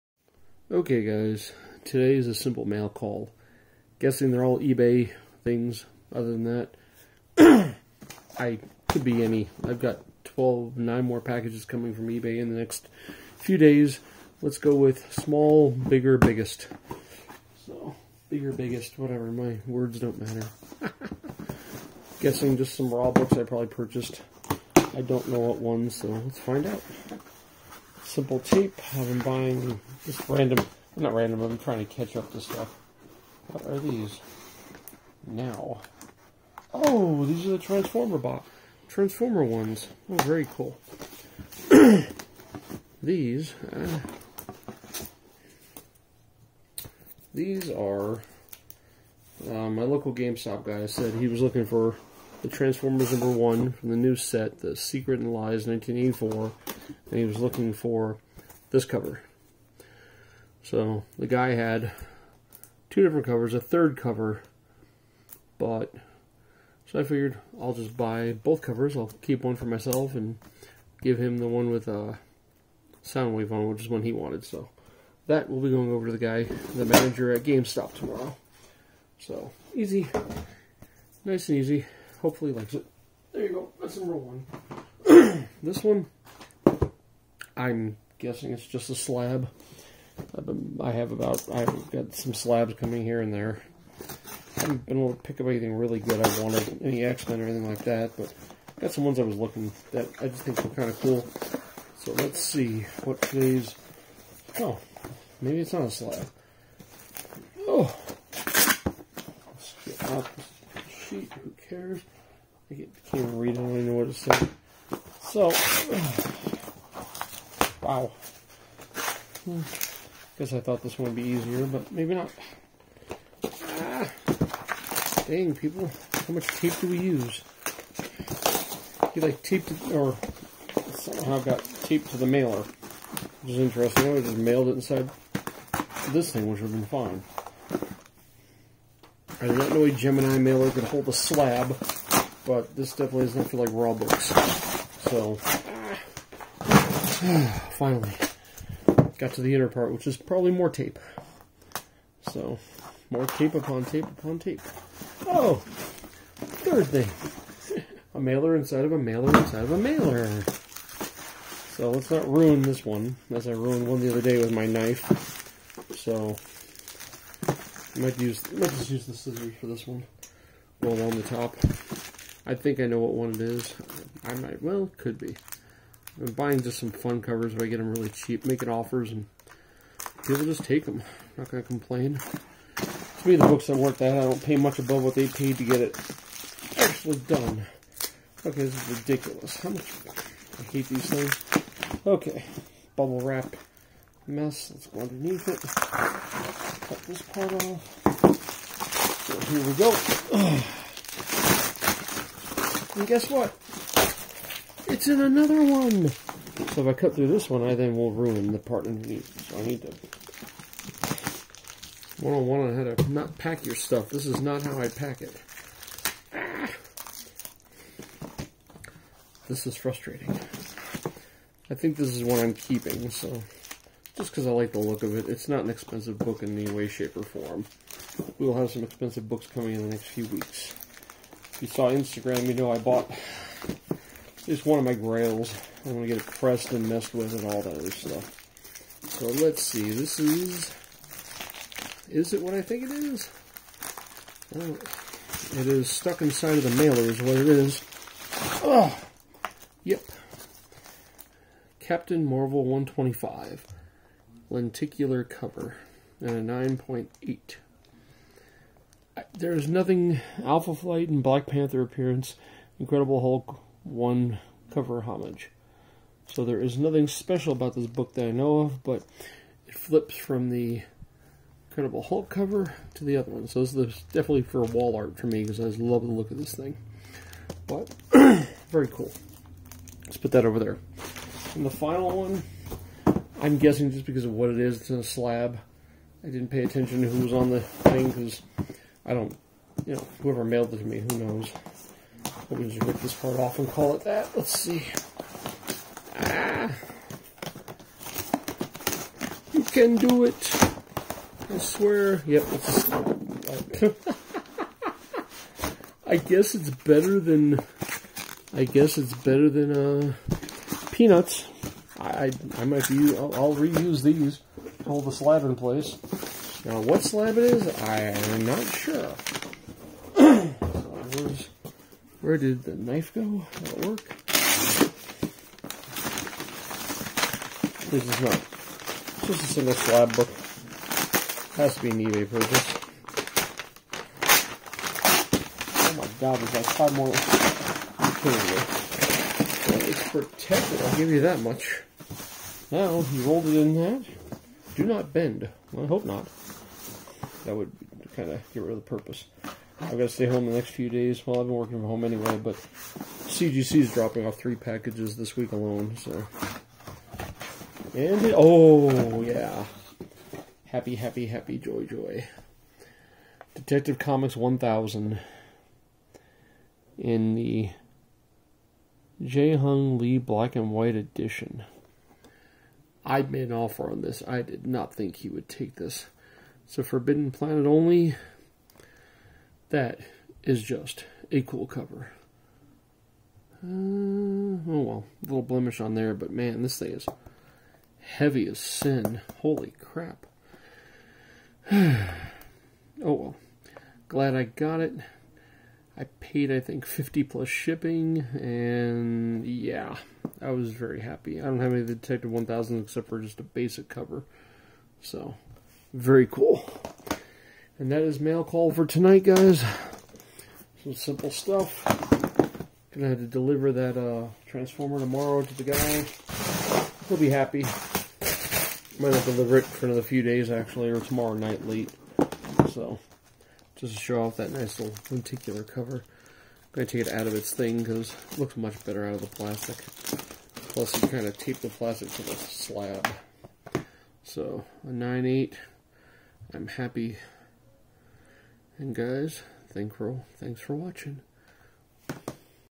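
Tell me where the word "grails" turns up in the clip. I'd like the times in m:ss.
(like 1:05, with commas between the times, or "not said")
3:54.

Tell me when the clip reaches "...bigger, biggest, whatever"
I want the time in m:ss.
0:18.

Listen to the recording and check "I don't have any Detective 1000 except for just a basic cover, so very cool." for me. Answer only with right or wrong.
right.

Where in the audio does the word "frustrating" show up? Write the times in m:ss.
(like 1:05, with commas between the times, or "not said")
3:39.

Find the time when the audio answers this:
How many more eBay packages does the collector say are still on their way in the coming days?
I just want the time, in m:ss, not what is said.
0:10.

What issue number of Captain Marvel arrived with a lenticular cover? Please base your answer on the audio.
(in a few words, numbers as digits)
125.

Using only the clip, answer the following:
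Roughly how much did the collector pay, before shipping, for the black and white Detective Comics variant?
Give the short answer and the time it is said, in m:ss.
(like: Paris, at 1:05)
50, at 6:36.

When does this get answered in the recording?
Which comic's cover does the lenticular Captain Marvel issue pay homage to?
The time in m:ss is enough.
4:22.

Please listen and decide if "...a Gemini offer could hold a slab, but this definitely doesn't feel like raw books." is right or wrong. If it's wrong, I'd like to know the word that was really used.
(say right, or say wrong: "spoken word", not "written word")
wrong: "mailer", not "offer".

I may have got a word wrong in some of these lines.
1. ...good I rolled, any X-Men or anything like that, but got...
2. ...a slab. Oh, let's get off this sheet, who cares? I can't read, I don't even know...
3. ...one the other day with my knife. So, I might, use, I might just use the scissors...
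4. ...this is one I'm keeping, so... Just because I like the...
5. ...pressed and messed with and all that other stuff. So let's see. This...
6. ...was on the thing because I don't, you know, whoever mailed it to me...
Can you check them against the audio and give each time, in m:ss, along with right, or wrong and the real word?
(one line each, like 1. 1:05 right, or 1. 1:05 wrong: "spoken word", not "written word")
1. 1:35 wrong: "wanted", not "rolled"
2. 1:45 right
3. 2:43 right
4. 3:41 right
5. 3:56 right
6. 4:47 right.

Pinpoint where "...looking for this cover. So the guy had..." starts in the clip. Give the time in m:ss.
0:57.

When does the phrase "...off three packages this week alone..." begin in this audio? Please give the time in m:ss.
5:54.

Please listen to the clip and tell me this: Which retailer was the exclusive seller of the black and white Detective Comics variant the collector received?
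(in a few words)
Forbidden Planet.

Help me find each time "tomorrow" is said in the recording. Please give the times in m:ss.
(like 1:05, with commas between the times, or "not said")
1:17, 6:54, 7:00.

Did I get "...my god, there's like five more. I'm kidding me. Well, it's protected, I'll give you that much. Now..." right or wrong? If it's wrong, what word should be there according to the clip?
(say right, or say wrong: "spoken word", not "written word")
right.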